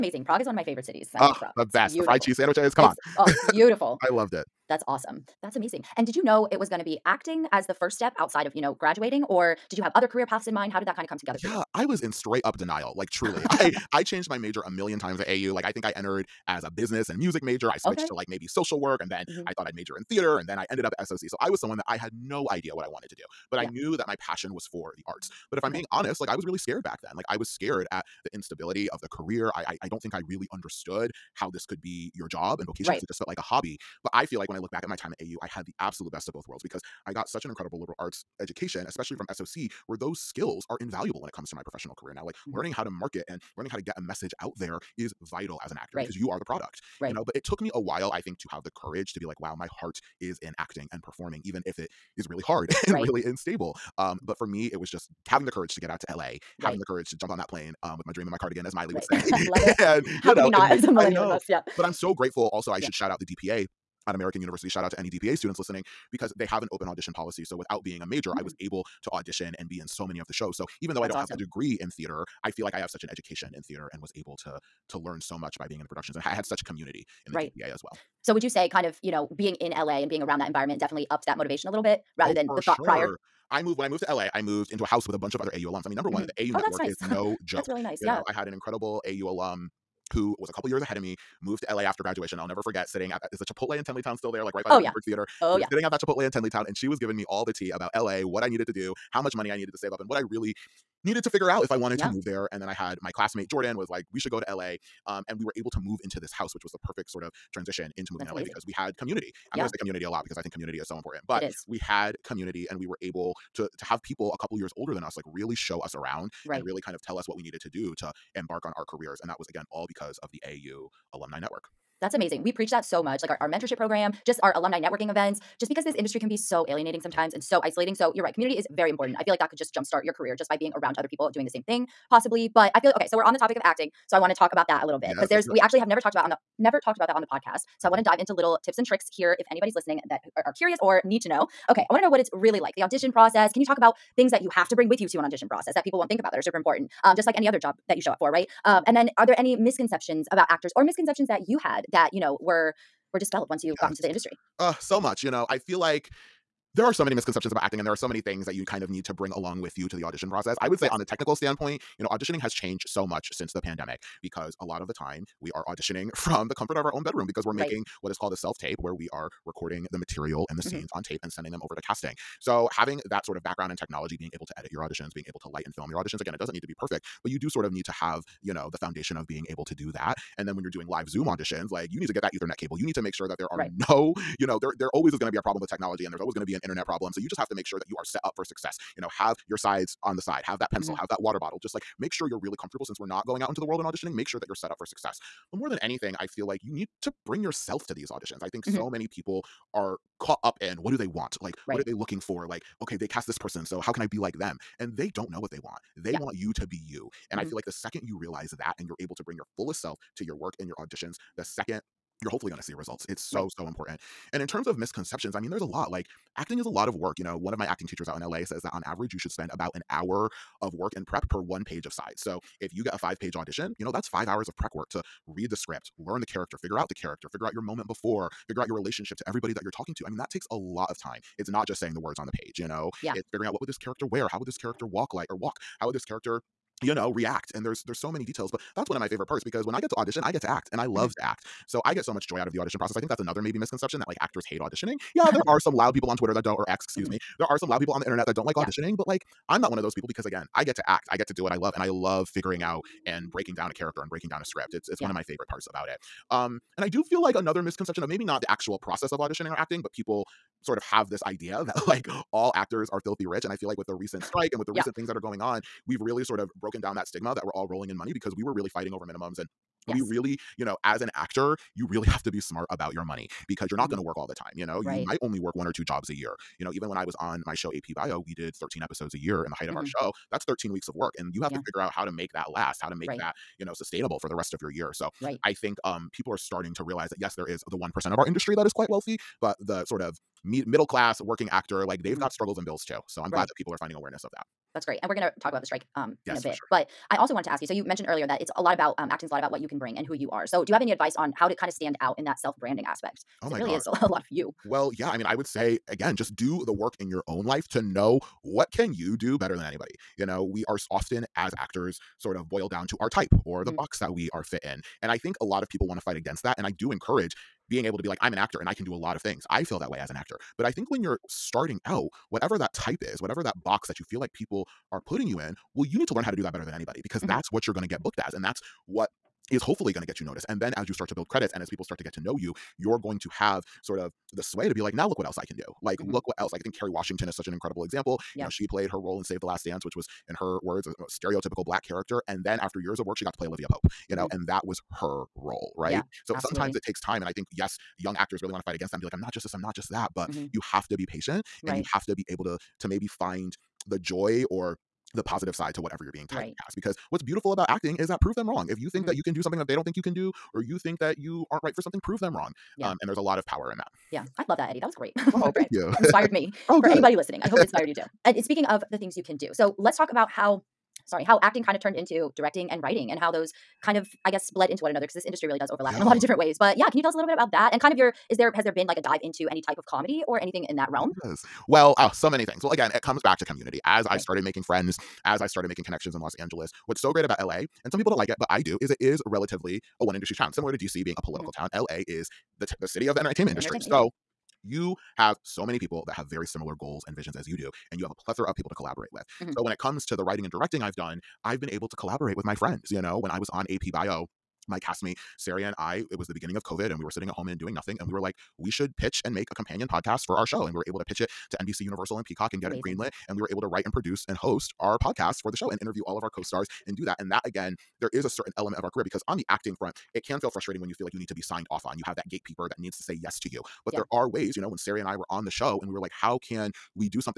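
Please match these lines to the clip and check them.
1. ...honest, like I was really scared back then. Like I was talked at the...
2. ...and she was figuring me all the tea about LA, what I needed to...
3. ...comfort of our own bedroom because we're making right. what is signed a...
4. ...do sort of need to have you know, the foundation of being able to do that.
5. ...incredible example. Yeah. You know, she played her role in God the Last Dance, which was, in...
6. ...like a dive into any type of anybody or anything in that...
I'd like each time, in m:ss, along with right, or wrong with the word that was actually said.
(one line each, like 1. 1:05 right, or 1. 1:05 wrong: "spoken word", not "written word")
1. 0:25 wrong: "scared", not "talked"
2. 1:36 wrong: "giving", not "figuring"
3. 2:46 wrong: "called", not "signed"
4. 2:57 right
5. 5:37 wrong: "Save", not "God"
6. 6:18 wrong: "comedy", not "anybody".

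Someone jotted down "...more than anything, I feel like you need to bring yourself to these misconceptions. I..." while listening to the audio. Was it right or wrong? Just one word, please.
wrong.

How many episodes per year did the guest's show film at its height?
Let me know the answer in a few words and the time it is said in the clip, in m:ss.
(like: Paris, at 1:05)
13, at 4:38.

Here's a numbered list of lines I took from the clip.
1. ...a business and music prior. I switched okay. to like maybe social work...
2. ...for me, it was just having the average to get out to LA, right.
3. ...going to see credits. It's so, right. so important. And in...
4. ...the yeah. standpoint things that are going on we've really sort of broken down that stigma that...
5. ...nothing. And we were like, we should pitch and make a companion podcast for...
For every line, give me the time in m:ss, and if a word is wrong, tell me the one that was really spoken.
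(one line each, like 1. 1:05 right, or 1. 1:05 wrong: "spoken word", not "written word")
1. 0:16 wrong: "major", not "prior"
2. 0:54 wrong: "courage", not "average"
3. 3:32 wrong: "results", not "credits"
4. 4:24 wrong: "recent", not "standpoint"
5. 6:47 right.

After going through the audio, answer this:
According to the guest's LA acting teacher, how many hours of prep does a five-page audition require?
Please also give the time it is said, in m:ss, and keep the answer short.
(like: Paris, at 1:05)
5, at 3:44.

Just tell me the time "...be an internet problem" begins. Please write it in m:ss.
3:06.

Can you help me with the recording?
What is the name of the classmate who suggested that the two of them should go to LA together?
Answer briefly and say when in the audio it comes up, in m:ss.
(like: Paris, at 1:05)
Jordan, at 1:43.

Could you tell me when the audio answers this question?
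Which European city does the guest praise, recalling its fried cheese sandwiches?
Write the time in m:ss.
0:00.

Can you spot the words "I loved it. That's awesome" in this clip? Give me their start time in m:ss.
0:04.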